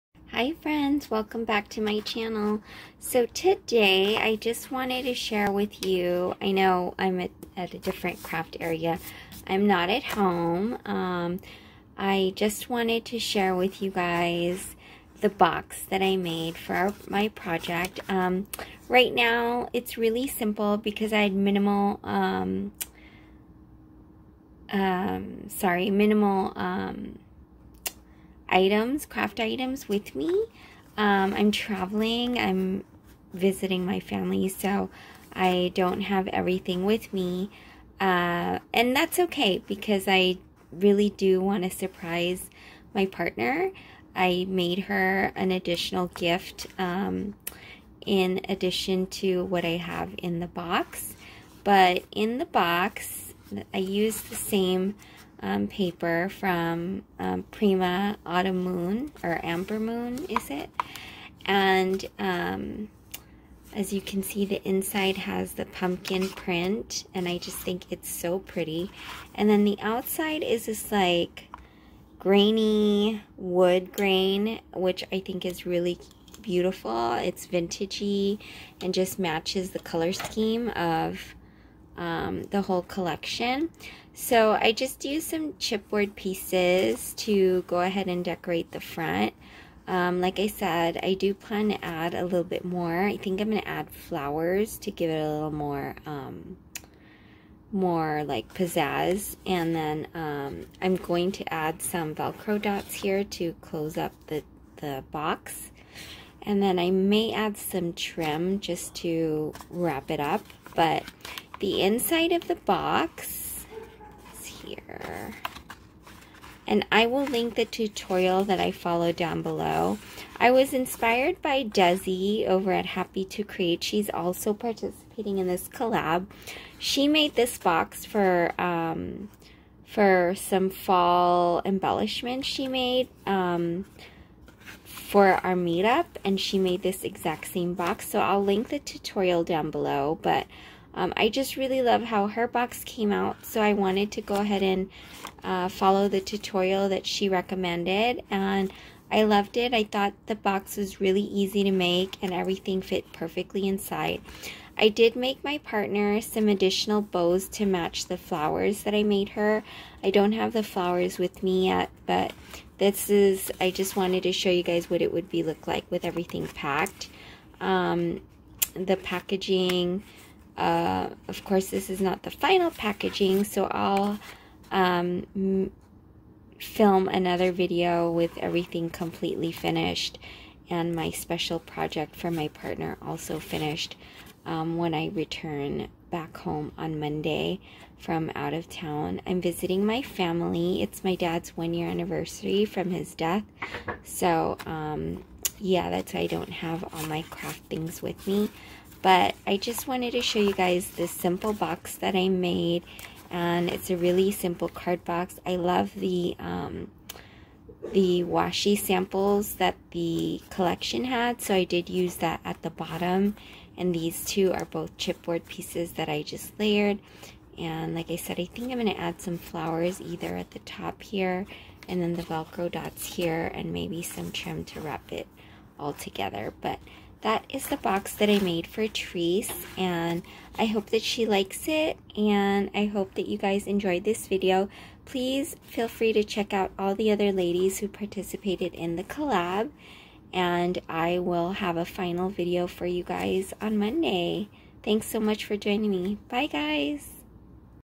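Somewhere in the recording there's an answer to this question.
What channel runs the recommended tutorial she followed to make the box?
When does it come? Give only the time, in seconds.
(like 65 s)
122 s.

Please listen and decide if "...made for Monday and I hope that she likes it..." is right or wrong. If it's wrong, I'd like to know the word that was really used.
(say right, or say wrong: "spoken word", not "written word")
wrong: "Trice", not "Monday".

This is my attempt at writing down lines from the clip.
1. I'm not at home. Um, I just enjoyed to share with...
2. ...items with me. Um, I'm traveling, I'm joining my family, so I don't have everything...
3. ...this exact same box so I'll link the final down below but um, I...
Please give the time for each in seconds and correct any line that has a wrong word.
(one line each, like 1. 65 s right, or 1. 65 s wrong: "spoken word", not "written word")
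1. 9 s wrong: "wanted", not "enjoyed"
2. 29 s wrong: "visiting", not "joining"
3. 136 s wrong: "tutorial", not "final".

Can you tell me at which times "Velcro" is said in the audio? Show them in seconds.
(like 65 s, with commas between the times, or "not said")
102 s, 222 s.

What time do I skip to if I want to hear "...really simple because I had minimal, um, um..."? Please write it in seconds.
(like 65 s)
19 s.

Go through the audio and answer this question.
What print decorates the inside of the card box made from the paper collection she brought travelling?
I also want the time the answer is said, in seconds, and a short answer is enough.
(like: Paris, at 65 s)
pumpkin print, at 65 s.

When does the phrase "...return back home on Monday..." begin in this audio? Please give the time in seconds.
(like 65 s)
185 s.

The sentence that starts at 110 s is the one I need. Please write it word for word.
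But the inside of the box is here.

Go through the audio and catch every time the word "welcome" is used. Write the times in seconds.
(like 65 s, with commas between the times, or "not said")
1 s.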